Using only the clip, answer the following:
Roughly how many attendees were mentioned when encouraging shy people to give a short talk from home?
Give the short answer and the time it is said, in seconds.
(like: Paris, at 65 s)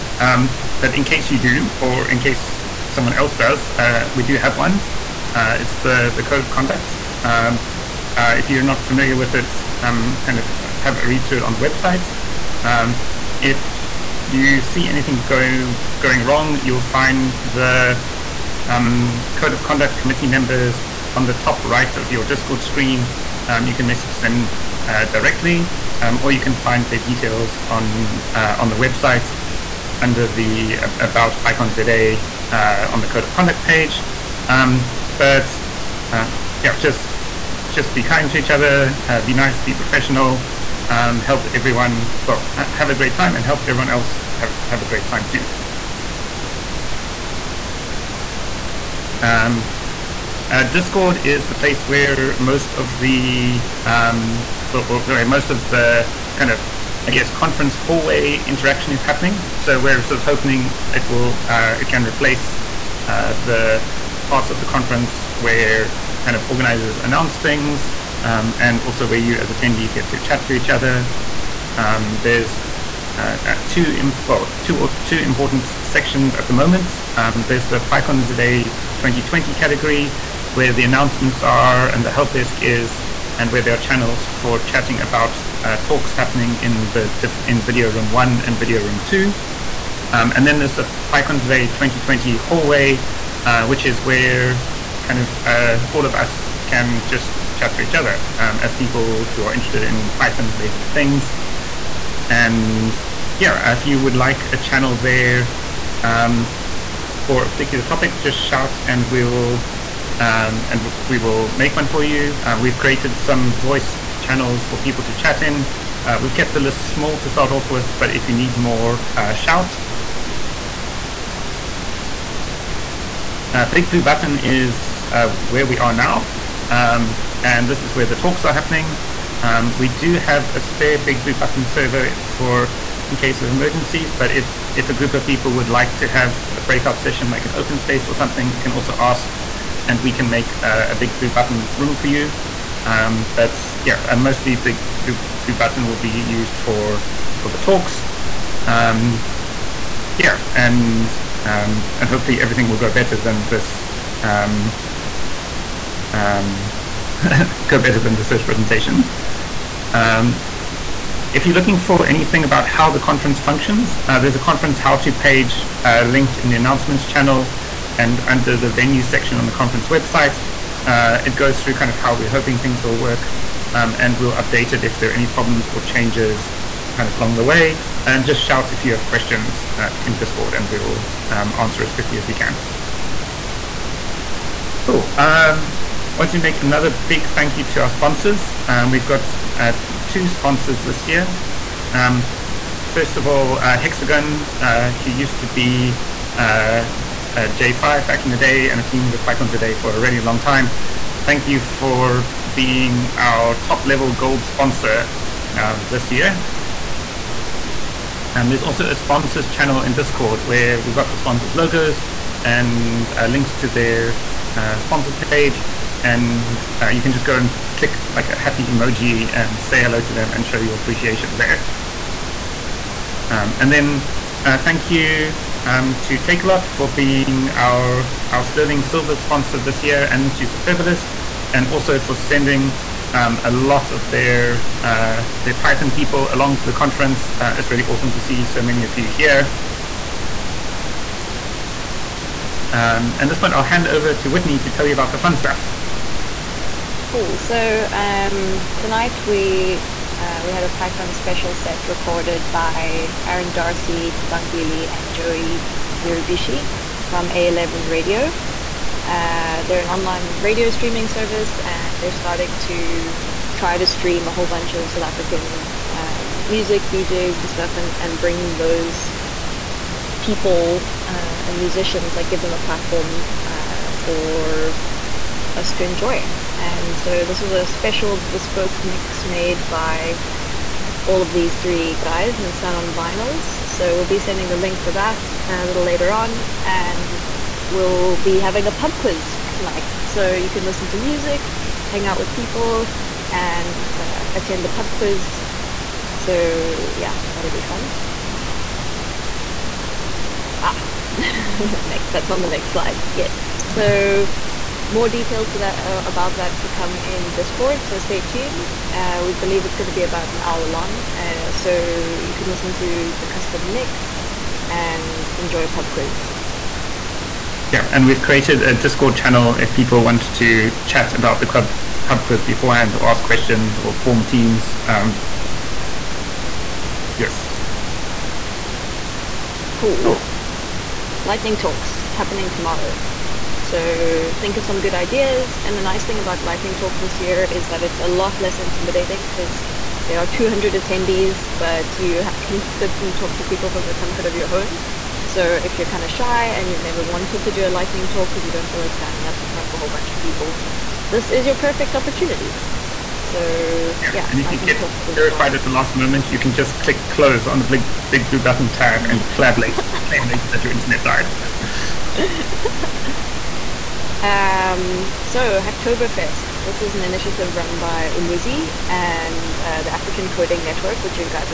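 200, at 340 s.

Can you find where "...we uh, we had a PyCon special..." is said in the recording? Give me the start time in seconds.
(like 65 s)
249 s.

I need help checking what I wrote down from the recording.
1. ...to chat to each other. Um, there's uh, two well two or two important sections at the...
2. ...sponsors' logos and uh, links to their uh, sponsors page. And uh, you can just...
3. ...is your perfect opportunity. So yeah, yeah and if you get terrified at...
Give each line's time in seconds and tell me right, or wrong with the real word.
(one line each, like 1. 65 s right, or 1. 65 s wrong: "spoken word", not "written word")
1. 70 s right
2. 211 s right
3. 351 s right.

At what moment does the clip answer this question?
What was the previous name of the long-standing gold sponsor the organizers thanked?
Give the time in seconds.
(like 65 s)
197 s.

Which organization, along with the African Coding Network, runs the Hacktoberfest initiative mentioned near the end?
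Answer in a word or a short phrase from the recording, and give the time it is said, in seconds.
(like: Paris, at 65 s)
Umuzi, at 368 s.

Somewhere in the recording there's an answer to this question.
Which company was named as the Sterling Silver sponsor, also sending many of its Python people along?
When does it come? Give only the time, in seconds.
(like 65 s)
226 s.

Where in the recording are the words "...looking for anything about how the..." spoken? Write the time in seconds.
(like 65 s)
161 s.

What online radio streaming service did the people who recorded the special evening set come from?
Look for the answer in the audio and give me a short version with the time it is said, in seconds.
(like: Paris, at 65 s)
A11 Radio, at 257 s.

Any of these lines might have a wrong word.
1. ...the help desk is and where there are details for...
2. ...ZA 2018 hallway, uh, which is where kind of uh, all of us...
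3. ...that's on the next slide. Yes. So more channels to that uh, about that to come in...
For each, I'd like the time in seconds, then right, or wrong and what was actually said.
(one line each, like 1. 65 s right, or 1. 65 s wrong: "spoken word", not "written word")
1. 82 s wrong: "channels", not "details"
2. 91 s wrong: "2020", not "2018"
3. 302 s wrong: "details", not "channels".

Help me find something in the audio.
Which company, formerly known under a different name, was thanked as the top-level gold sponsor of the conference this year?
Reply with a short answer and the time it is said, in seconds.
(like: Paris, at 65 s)
Hexagon, at 193 s.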